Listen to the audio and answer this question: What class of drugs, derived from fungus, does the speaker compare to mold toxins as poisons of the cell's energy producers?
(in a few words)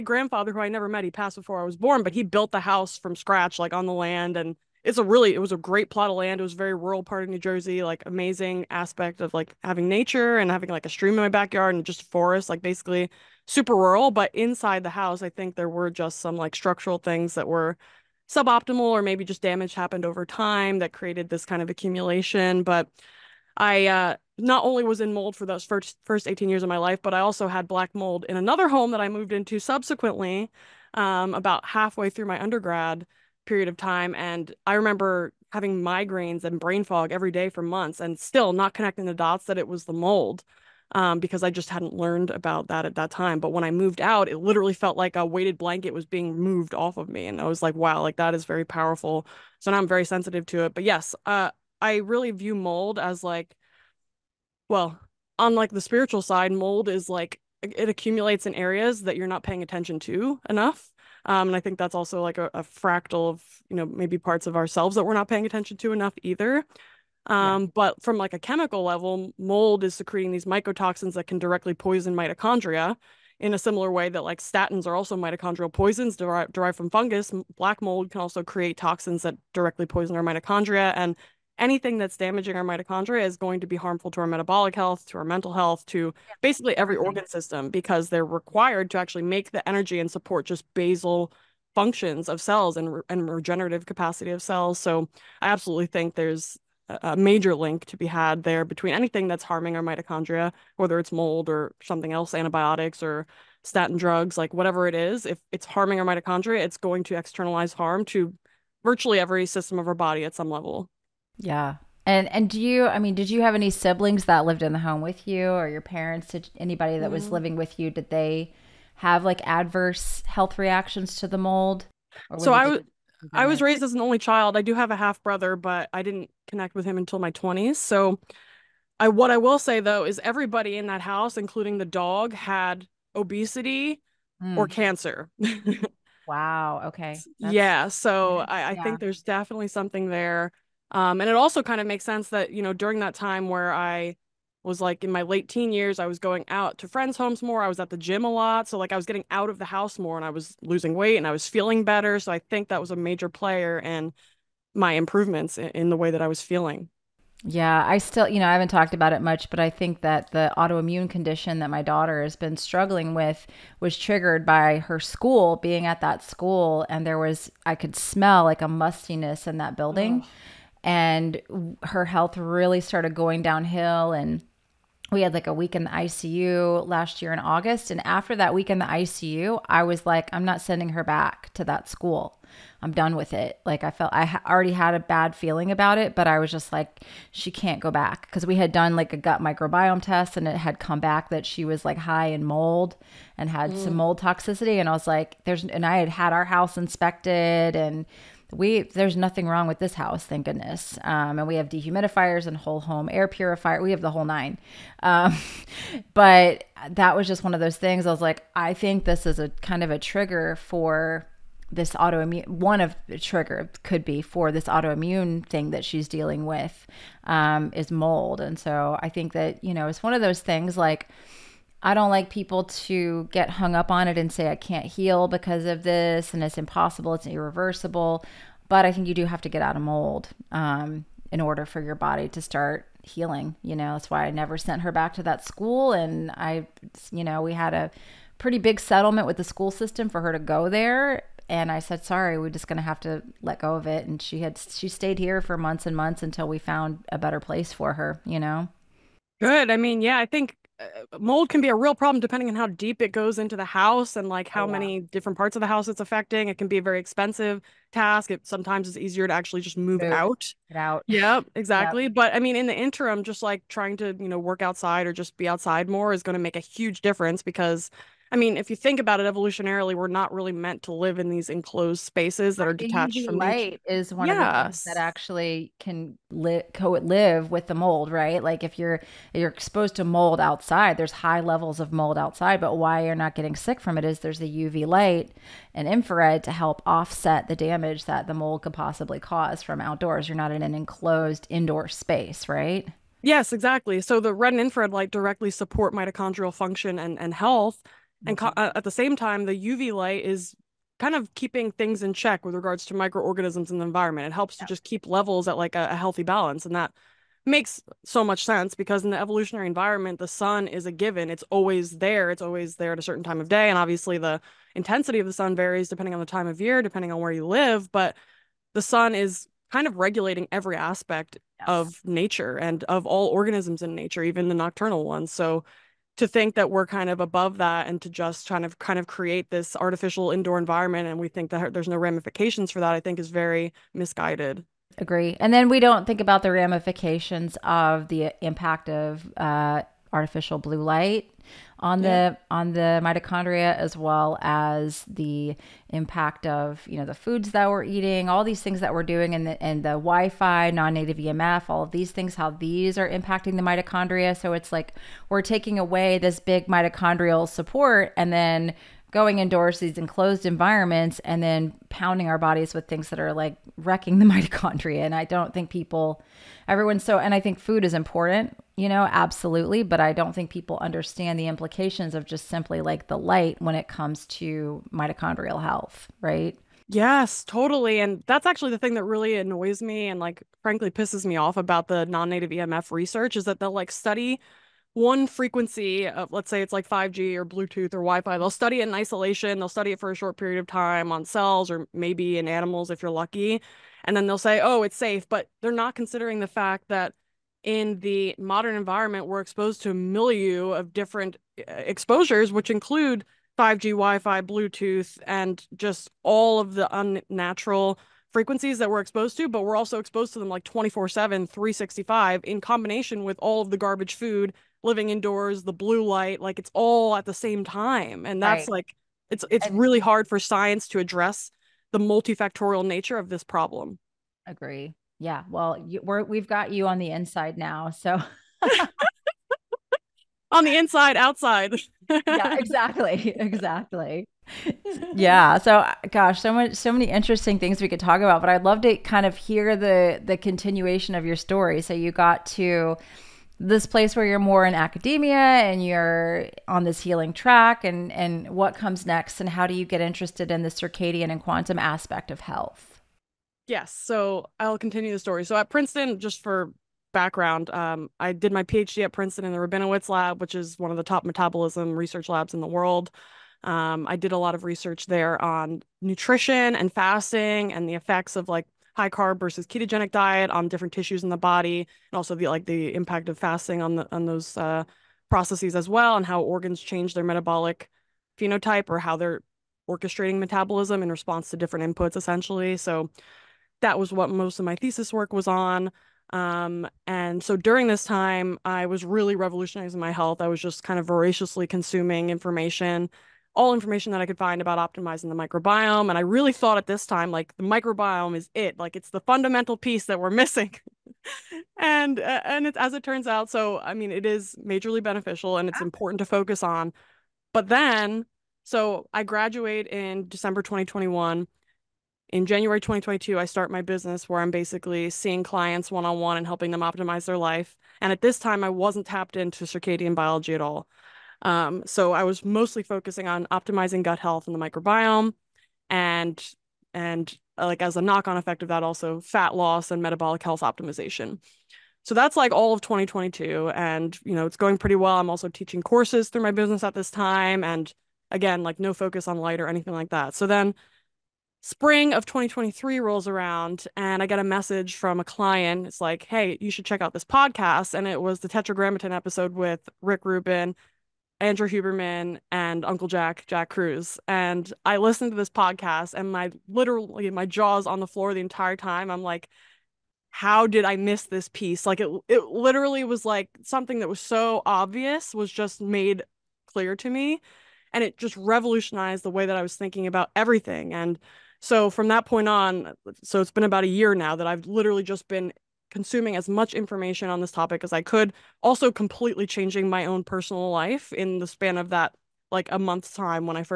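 statins.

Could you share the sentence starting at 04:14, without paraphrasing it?
many different parts of the house it's affecting.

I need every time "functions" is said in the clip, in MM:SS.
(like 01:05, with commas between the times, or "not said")
01:31, 04:56.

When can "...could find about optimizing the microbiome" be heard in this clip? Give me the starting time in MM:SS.
08:14.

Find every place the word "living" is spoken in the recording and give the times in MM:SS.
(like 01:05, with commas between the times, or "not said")
01:57, 06:54.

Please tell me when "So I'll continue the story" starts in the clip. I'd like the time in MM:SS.
07:33.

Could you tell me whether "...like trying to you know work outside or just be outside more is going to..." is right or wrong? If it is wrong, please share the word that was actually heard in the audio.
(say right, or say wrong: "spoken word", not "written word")
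right.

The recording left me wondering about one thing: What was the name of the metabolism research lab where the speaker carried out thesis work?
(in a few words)
Rabinowitz lab.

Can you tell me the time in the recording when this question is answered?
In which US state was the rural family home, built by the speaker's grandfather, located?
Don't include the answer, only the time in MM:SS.
00:07.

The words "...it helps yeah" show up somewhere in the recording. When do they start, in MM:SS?
05:04.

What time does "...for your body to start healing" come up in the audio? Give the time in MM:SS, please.
03:51.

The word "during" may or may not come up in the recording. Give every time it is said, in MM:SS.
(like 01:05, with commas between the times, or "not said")
02:22, 08:07.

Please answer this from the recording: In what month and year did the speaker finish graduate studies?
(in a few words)
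December 2021.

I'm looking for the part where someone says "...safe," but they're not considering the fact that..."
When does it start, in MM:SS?
06:34.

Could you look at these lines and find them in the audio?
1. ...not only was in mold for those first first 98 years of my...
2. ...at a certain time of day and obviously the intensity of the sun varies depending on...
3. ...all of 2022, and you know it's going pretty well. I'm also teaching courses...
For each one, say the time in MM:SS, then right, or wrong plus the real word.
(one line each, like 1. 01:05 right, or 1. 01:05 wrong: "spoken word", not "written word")
1. 00:24 wrong: "18", not "98"
2. 05:12 right
3. 08:52 right.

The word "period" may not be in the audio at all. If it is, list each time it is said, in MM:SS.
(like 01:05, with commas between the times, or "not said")
00:33, 06:30.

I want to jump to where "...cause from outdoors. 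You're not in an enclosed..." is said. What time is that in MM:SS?
04:49.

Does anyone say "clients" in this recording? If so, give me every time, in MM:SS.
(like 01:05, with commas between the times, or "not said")
08:35, 09:05.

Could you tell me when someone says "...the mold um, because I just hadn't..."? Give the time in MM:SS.
00:39.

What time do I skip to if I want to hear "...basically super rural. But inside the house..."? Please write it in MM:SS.
00:12.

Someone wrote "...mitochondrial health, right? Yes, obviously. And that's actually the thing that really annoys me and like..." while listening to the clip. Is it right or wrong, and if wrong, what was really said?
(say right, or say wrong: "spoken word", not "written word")
wrong: "totally", not "obviously".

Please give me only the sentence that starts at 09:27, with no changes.
And it just revolutionized the way that I was thinking about everything.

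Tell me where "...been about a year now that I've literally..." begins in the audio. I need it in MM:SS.
09:33.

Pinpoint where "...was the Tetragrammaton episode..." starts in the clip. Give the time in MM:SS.
09:08.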